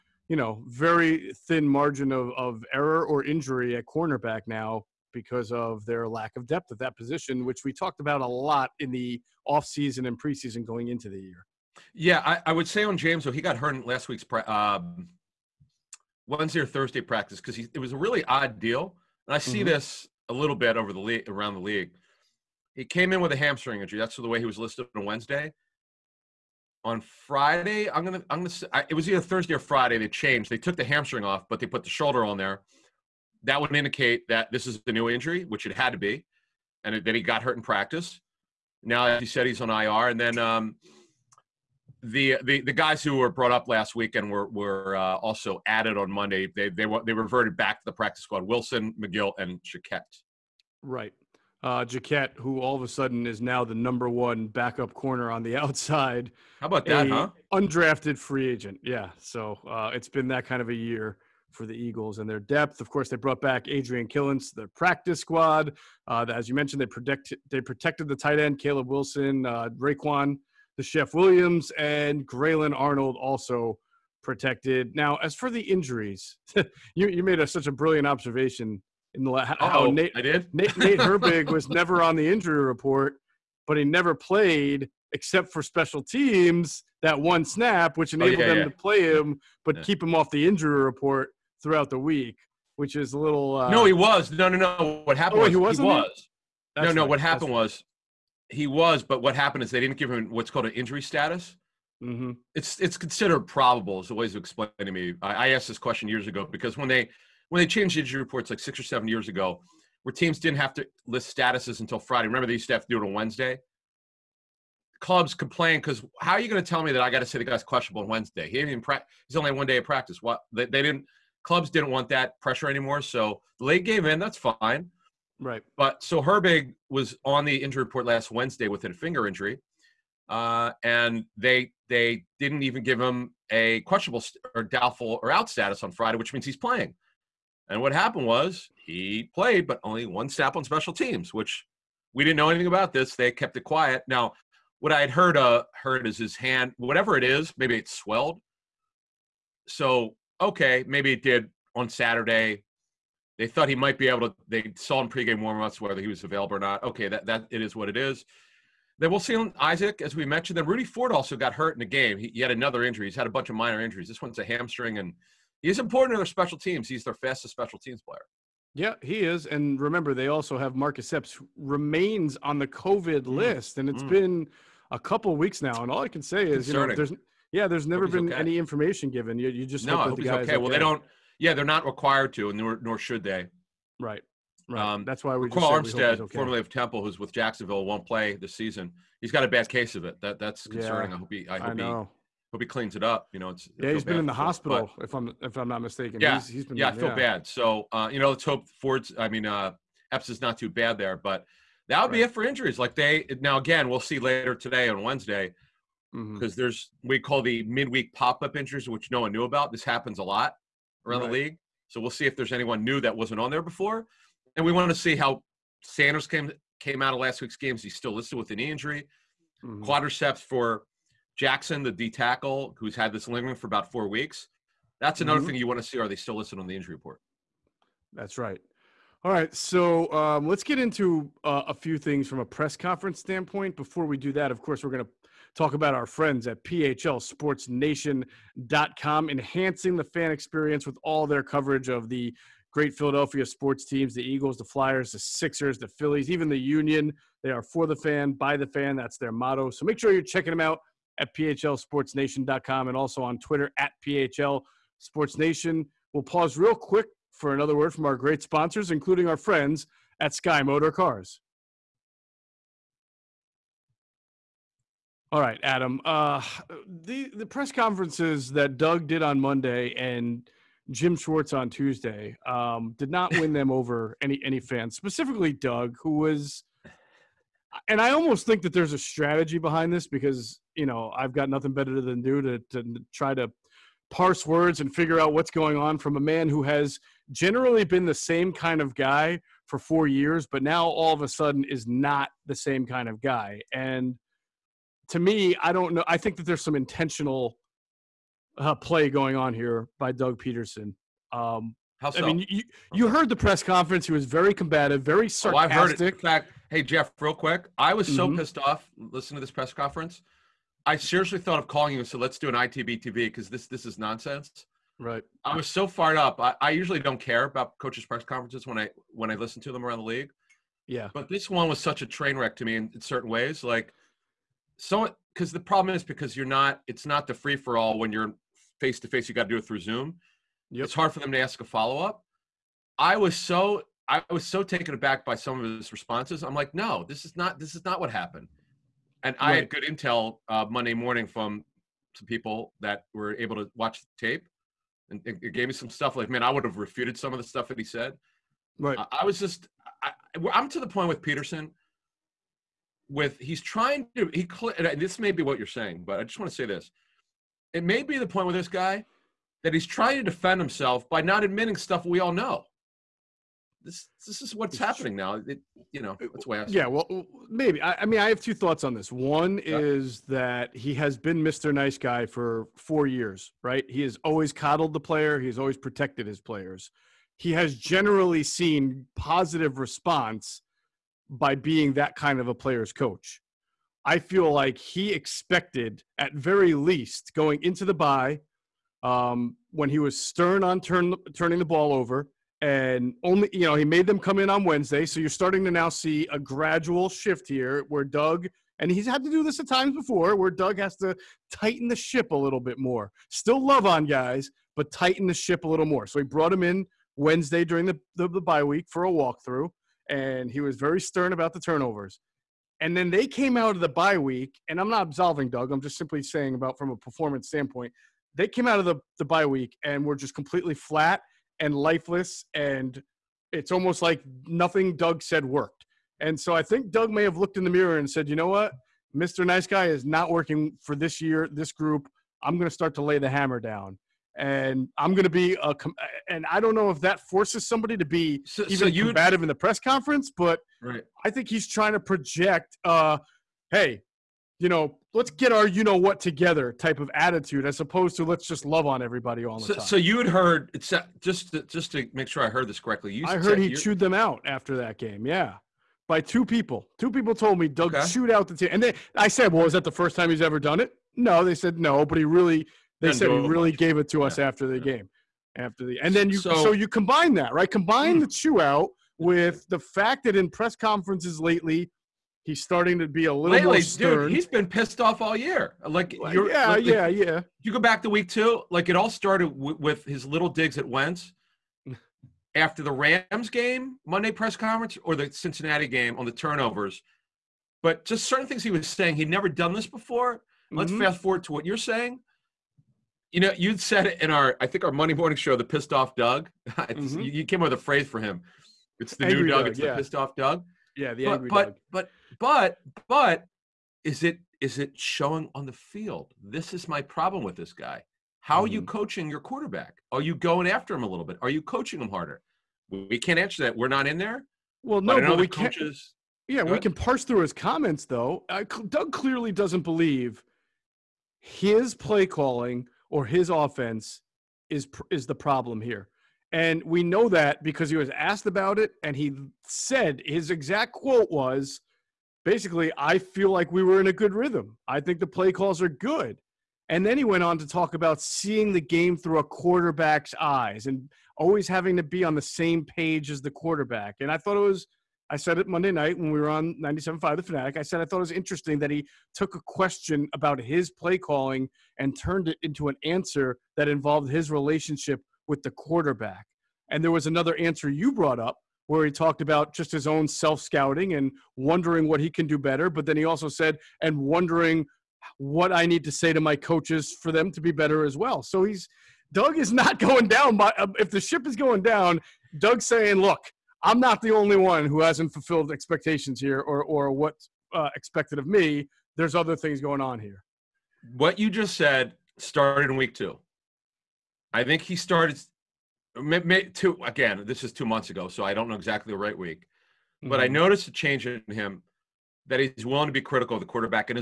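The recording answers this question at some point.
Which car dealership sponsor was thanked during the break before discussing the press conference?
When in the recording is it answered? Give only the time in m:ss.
4:20.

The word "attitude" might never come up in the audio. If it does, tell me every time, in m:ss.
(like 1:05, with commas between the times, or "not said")
7:27.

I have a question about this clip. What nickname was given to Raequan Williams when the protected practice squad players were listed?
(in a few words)
the Chef.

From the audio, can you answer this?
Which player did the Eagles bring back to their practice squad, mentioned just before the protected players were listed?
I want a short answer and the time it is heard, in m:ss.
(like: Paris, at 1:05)
Adrian Killins, at 1:03.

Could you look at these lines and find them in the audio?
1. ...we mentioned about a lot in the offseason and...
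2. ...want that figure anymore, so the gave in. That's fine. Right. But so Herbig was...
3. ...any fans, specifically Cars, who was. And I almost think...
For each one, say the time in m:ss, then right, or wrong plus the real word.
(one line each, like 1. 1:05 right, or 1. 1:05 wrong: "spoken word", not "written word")
1. 0:07 wrong: "talked", not "mentioned"
2. 2:01 wrong: "pressure", not "figure"
3. 4:34 wrong: "Doug", not "Cars".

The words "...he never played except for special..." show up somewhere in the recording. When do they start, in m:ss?
1:23.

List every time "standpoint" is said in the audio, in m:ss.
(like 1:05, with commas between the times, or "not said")
3:53, 6:57.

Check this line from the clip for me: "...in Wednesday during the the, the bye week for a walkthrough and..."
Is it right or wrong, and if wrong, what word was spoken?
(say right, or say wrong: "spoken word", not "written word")
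right.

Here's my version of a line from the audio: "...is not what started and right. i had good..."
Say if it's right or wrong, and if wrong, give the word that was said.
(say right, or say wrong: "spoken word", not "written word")
wrong: "happened", not "started".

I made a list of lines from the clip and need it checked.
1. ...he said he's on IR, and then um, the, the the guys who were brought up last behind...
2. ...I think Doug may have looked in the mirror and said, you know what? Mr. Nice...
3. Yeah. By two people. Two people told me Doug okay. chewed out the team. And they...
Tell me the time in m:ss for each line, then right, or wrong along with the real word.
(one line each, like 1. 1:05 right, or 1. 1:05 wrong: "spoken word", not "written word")
1. 0:39 wrong: "weekend", not "behind"
2. 7:06 right
3. 7:35 right.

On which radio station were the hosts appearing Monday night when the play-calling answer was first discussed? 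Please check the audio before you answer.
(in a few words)
97.5 The Fanatic.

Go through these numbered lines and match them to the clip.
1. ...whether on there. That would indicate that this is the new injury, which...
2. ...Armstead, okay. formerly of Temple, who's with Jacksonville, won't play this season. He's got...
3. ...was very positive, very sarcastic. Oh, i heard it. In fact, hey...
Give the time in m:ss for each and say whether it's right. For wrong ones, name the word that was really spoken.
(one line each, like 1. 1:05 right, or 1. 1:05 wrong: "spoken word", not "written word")
1. 0:31 wrong: "shoulder", not "whether"
2. 3:05 right
3. 5:04 wrong: "combative", not "positive".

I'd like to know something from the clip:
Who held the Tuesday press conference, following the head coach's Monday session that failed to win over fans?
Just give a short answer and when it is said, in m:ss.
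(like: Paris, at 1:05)
Jim Schwartz, at 4:30.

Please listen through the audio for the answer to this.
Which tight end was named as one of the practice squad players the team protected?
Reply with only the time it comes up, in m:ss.
1:08.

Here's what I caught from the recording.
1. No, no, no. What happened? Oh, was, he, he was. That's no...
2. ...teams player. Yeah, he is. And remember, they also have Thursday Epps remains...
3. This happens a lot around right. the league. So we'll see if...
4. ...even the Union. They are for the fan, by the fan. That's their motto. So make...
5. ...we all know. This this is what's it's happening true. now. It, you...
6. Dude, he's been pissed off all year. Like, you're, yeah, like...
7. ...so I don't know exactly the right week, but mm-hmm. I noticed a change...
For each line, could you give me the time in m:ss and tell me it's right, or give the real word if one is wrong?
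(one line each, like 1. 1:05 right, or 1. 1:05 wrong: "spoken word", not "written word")
1. 1:34 right
2. 2:47 wrong: "Marcus", not "Thursday"
3. 3:29 right
4. 4:06 right
5. 6:02 right
6. 7:54 right
7. 9:48 right.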